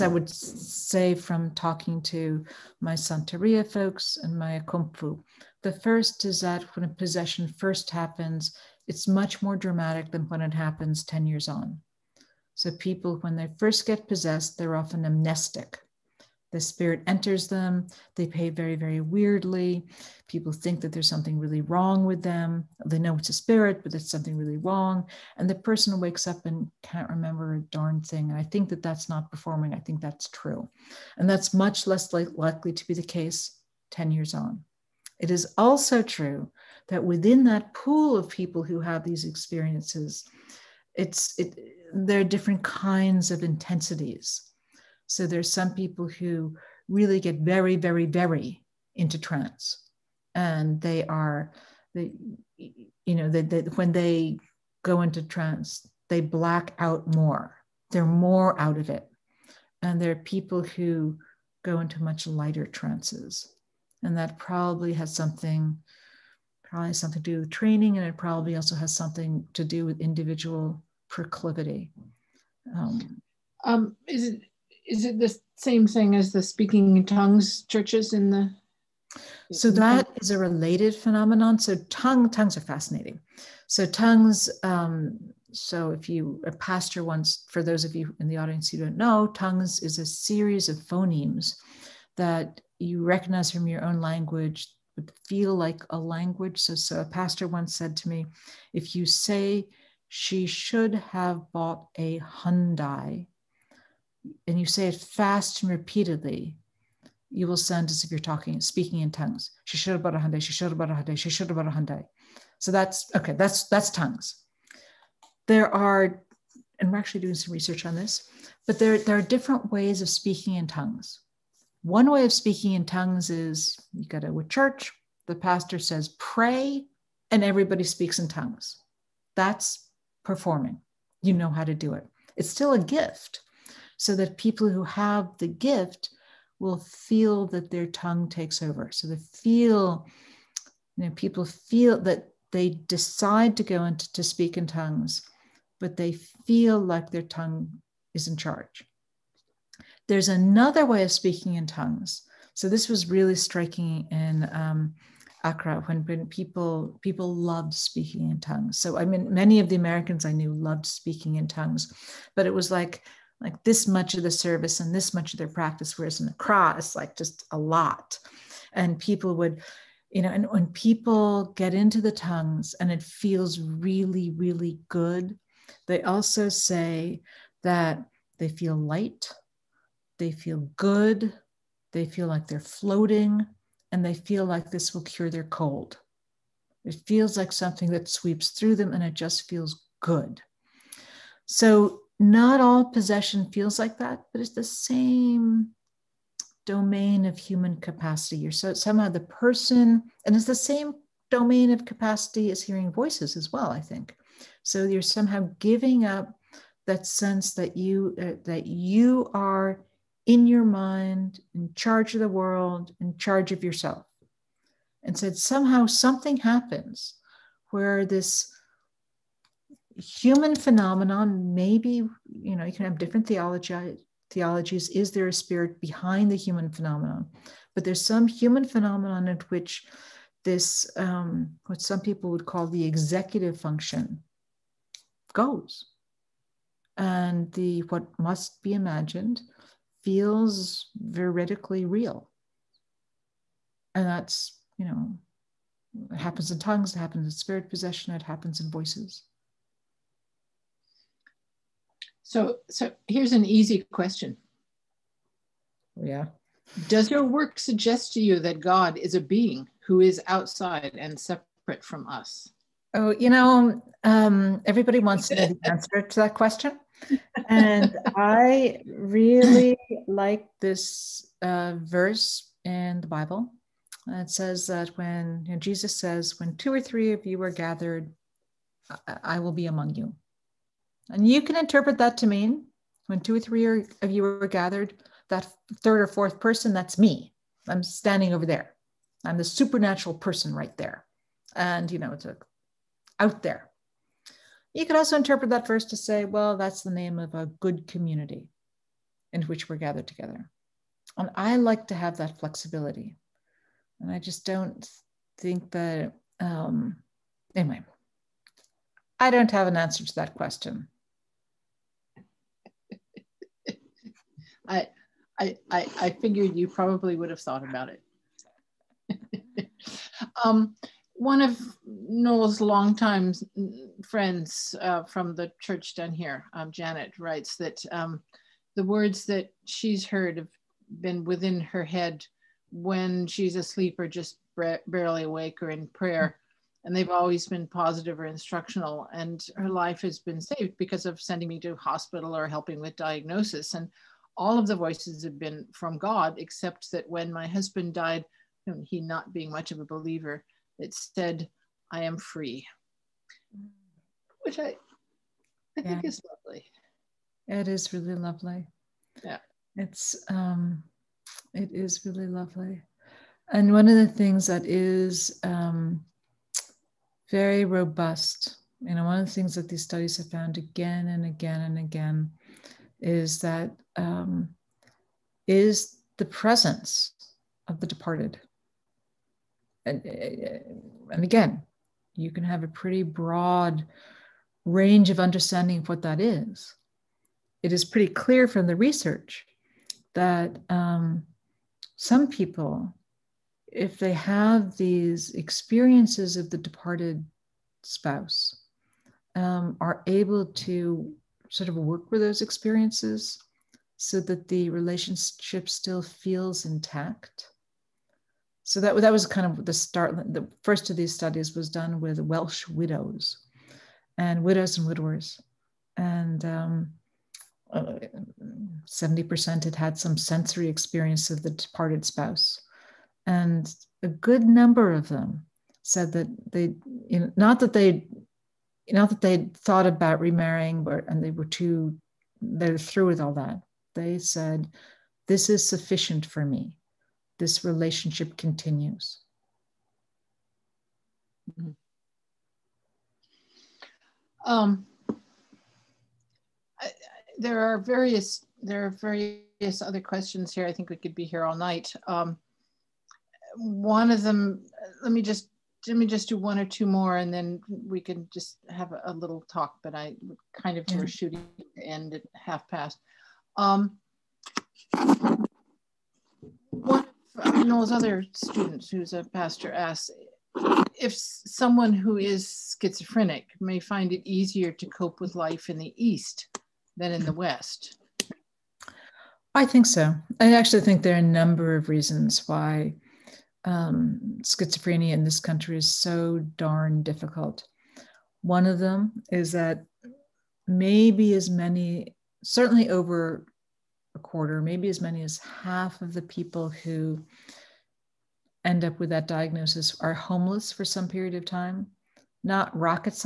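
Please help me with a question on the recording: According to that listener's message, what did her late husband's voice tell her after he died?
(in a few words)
I am free.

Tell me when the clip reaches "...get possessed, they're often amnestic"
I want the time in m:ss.
0:13.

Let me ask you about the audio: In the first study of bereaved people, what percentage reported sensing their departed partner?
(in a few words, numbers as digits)
70%.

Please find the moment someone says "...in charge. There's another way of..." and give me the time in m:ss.
2:28.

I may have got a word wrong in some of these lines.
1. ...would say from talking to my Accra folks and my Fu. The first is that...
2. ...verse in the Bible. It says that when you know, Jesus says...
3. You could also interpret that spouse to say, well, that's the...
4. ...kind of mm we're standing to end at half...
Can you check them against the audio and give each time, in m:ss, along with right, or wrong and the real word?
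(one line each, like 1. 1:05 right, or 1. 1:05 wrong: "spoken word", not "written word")
1. 0:00 wrong: "Santeria", not "Accra"
2. 4:31 right
3. 4:54 wrong: "verse", not "spouse"
4. 7:40 wrong: "shooting", not "standing".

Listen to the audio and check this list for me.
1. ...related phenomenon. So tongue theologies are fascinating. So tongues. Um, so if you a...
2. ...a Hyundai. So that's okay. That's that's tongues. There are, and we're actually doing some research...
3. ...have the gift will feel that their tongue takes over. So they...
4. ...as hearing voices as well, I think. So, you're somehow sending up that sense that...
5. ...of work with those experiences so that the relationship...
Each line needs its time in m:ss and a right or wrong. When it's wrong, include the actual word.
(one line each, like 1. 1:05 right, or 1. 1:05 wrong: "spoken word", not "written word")
1. 1:20 wrong: "tongues", not "theologies"
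2. 1:51 right
3. 2:14 right
4. 3:22 wrong: "giving", not "sending"
5. 6:41 right.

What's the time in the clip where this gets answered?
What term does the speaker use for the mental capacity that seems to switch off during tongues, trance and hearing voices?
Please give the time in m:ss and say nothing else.
3:52.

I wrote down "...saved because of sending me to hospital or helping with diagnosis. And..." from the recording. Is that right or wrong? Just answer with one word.
right.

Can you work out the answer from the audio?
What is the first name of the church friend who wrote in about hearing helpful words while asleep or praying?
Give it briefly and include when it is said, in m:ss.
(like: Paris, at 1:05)
Janet, at 5:26.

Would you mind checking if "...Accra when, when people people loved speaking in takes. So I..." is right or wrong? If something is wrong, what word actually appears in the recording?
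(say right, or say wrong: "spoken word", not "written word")
wrong: "tongues", not "takes".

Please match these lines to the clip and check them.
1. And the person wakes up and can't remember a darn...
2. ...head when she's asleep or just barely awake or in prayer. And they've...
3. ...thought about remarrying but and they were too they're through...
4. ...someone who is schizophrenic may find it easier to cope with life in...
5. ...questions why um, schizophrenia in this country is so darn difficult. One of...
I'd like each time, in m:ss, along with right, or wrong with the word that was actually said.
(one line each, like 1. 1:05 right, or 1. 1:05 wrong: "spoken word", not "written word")
1. 0:25 right
2. 5:31 right
3. 7:09 right
4. 7:51 right
5. 8:01 wrong: "reasons", not "questions".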